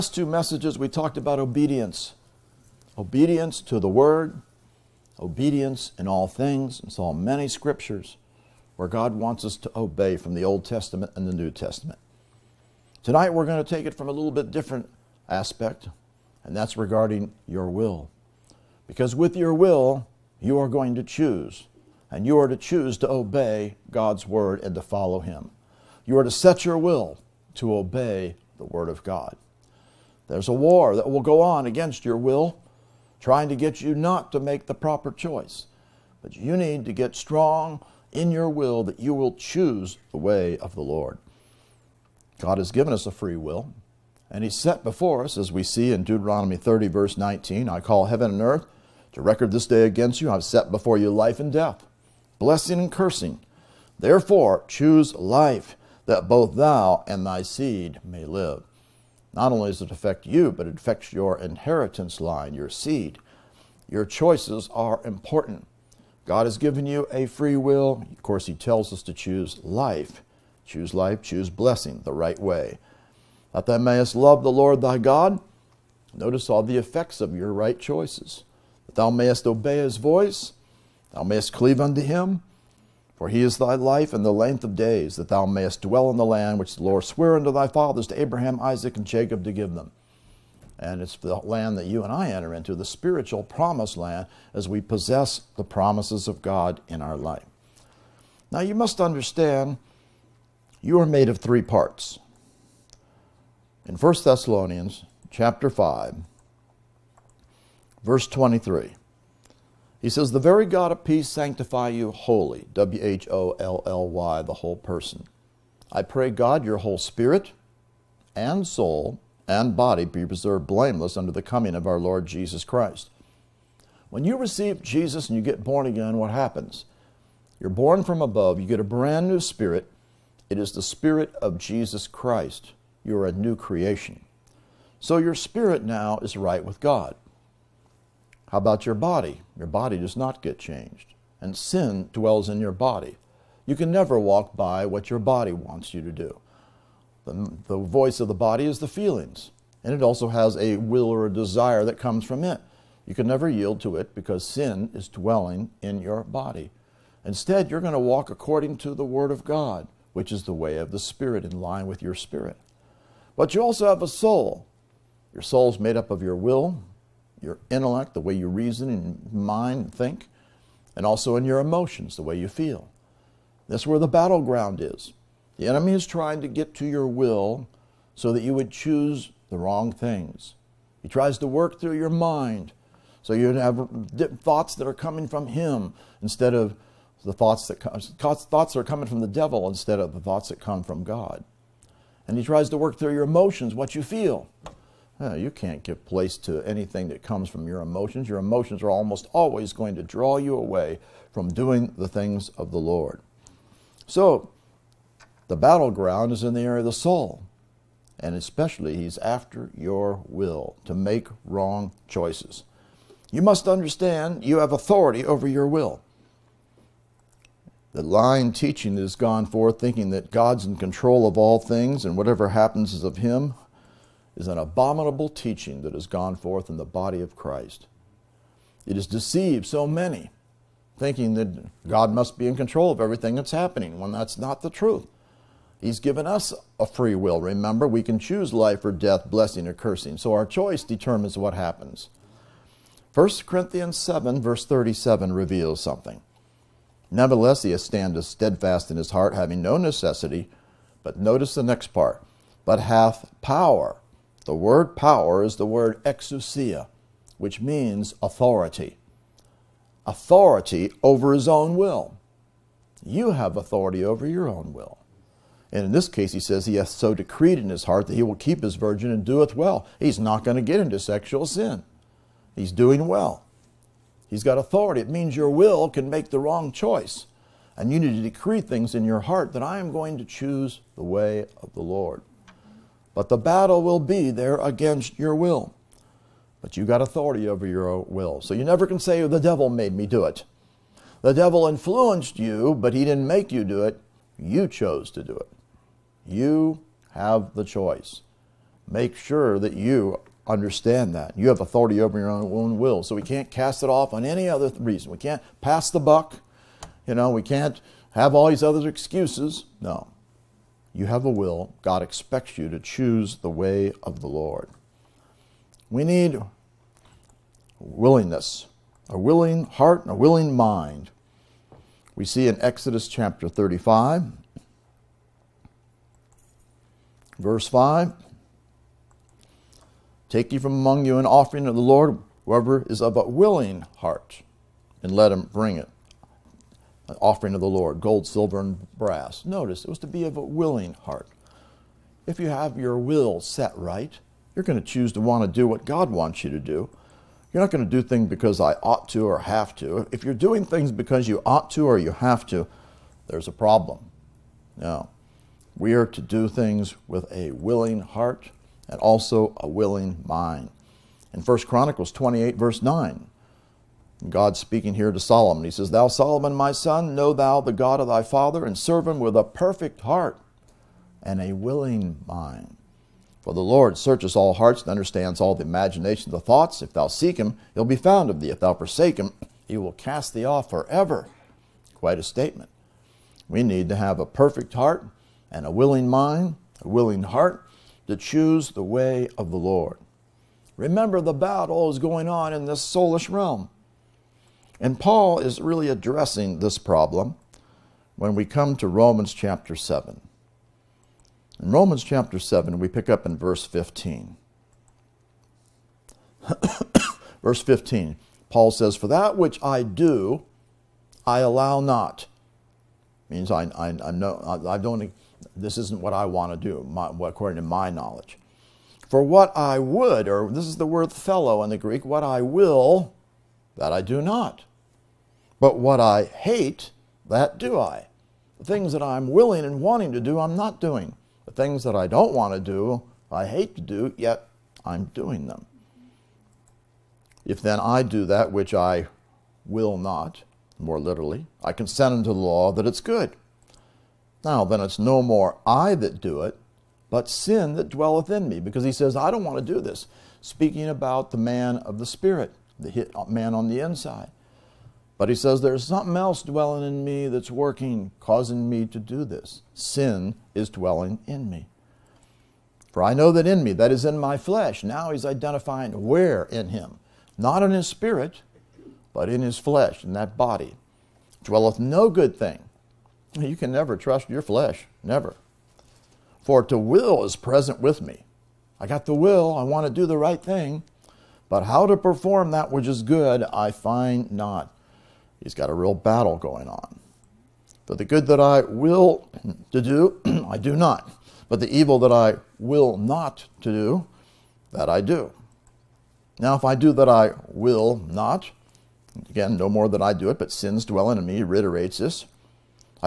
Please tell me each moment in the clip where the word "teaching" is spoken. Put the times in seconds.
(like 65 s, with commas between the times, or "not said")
218 s, 225 s.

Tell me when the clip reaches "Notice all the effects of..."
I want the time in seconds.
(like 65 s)
76 s.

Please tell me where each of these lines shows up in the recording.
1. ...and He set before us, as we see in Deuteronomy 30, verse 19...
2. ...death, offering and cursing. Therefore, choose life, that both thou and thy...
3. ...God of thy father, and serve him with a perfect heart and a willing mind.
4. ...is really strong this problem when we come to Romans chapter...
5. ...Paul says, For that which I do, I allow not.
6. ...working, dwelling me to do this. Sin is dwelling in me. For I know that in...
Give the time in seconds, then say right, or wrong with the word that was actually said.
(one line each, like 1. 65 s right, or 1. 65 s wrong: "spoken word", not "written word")
1. 44 s right
2. 51 s wrong: "blessing", not "offering"
3. 367 s right
4. 395 s wrong: "addressing", not "strong"
5. 408 s right
6. 457 s wrong: "causing", not "dwelling".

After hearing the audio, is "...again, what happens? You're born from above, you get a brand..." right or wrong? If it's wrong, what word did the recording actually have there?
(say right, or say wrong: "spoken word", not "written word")
right.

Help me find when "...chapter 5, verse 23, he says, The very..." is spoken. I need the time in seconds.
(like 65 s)
105 s.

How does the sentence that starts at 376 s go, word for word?
If thou seek him, he'll be found of thee.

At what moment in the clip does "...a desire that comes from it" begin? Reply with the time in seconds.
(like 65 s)
151 s.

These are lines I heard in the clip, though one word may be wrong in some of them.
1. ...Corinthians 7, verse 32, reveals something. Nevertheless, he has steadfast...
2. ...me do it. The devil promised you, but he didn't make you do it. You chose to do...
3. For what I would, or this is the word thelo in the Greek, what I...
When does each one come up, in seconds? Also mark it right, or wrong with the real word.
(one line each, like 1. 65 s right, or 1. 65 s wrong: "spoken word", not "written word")
1. 243 s wrong: "37", not "32"
2. 289 s wrong: "influenced", not "promised"
3. 419 s right.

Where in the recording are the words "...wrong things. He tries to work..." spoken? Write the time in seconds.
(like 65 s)
179 s.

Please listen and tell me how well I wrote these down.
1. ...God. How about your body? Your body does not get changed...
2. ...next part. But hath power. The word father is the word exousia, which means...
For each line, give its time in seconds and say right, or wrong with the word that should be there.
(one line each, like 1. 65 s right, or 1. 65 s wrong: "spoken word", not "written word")
1. 136 s right
2. 251 s wrong: "power", not "father".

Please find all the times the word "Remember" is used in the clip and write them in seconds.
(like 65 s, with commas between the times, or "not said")
237 s, 390 s.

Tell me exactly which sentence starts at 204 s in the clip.
So, the battleground is in the area of the soul.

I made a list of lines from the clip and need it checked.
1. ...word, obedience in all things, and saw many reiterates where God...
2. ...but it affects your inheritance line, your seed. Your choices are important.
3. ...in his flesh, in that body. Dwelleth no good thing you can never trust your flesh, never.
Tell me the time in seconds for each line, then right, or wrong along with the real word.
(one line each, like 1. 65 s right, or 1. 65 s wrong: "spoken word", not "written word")
1. 3 s wrong: "scriptures", not "reiterates"
2. 60 s right
3. 469 s right.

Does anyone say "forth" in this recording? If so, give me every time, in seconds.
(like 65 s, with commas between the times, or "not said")
219 s, 226 s.